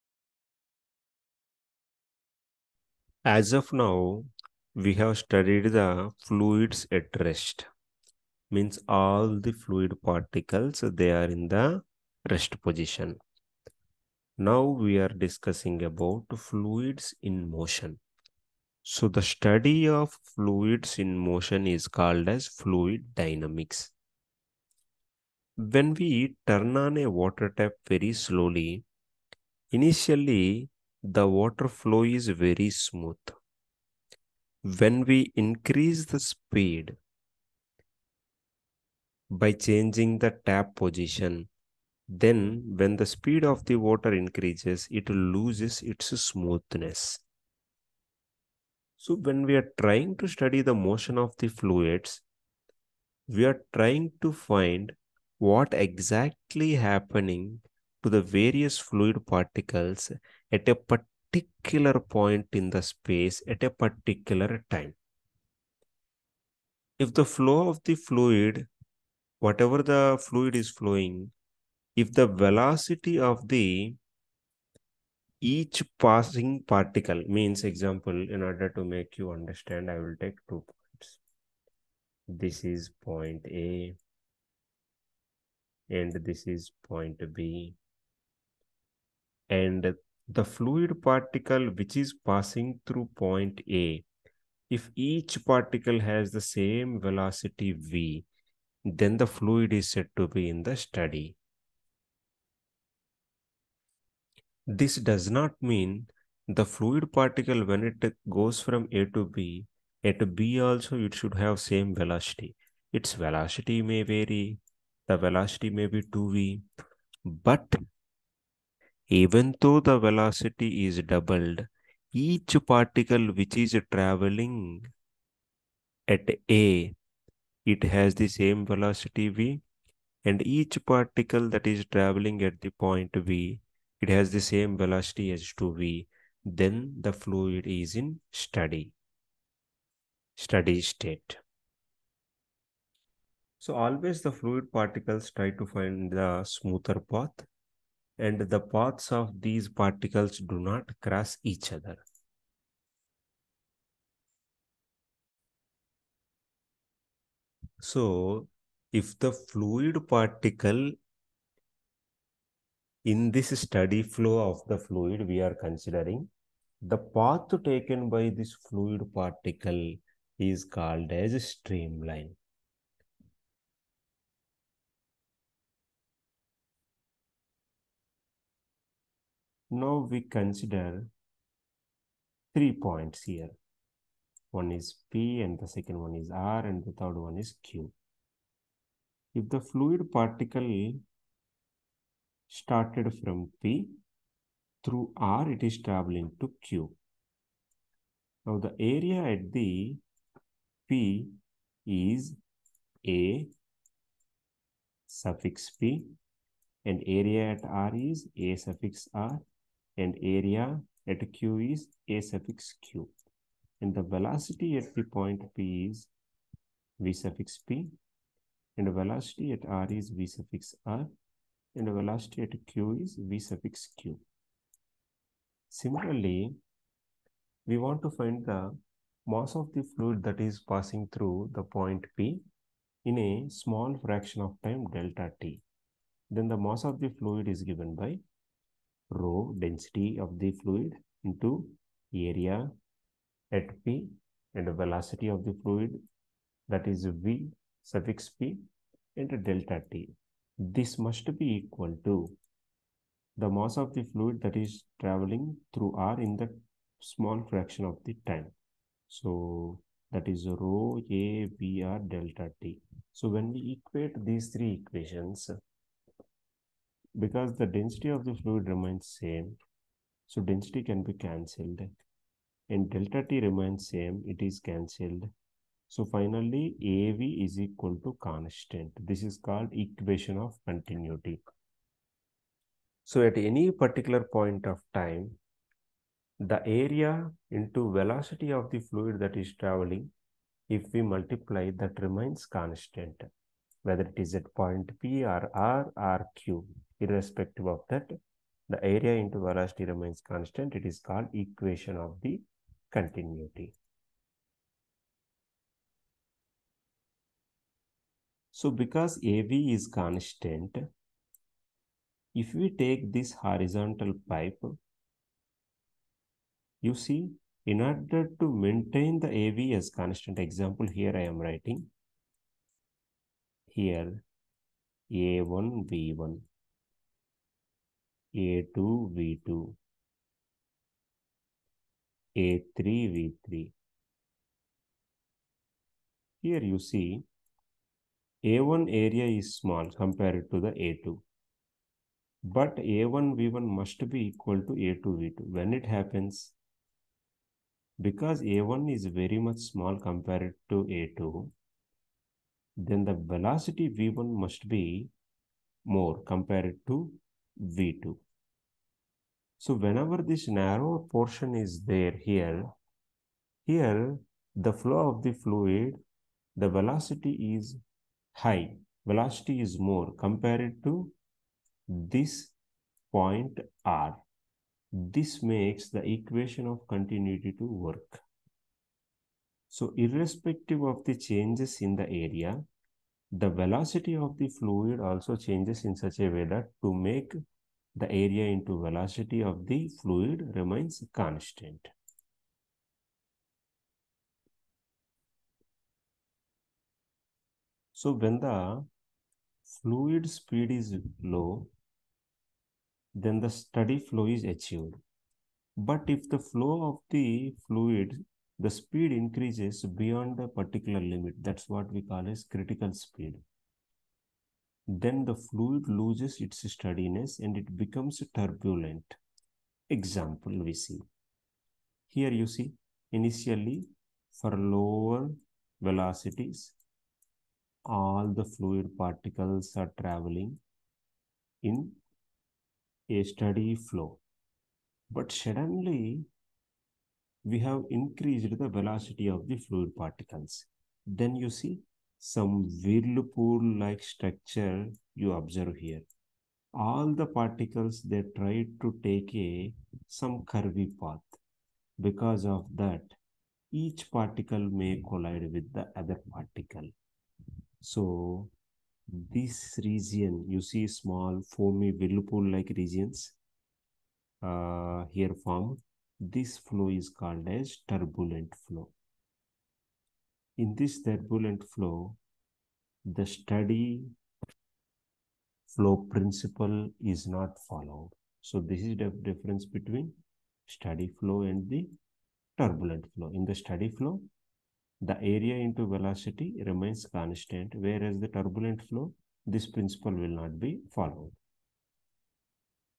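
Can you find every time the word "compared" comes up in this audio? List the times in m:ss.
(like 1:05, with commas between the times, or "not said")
5:40, 5:50, 5:56, 6:10.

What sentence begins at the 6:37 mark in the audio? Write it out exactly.
So when the fluid speed is low, then the steady flow is achieved.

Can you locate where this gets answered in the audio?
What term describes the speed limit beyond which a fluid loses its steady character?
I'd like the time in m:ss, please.
6:52.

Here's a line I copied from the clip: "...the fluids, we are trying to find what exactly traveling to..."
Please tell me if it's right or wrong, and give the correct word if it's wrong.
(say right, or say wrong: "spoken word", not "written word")
wrong: "happening", not "traveling".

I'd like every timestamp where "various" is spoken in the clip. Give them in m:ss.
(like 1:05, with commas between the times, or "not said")
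0:58.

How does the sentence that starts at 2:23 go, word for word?
So always the fluid particles try to find the smoother path and the paths of these particles do not cross each other.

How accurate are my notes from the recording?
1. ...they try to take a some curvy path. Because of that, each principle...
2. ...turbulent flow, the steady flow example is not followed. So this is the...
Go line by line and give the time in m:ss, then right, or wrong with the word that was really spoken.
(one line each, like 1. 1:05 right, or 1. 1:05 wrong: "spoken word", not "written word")
1. 7:28 wrong: "particle", not "principle"
2. 7:51 wrong: "principle", not "example".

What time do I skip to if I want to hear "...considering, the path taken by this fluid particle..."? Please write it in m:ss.
2:45.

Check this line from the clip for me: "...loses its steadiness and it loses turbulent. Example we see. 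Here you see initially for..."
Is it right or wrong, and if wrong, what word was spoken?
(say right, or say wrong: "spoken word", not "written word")
wrong: "becomes", not "loses".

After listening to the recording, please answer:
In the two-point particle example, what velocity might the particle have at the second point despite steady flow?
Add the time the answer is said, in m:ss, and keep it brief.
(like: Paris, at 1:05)
2V, at 1:56.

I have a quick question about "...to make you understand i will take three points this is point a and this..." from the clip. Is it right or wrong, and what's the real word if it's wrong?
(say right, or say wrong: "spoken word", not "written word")
wrong: "two", not "three".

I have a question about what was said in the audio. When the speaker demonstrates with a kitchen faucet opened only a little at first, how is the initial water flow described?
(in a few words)
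very smooth.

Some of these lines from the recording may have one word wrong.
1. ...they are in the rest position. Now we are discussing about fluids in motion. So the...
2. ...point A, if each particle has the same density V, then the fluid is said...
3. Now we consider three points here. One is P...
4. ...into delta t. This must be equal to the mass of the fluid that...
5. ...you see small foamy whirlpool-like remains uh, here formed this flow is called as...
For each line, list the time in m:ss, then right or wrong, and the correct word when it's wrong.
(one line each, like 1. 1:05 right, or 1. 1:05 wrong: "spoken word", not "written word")
1. 0:10 right
2. 1:33 wrong: "velocity", not "density"
3. 2:59 right
4. 4:09 right
5. 7:40 wrong: "regions", not "remains".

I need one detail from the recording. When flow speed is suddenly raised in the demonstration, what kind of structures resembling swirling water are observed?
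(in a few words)
whirlpool-like structure.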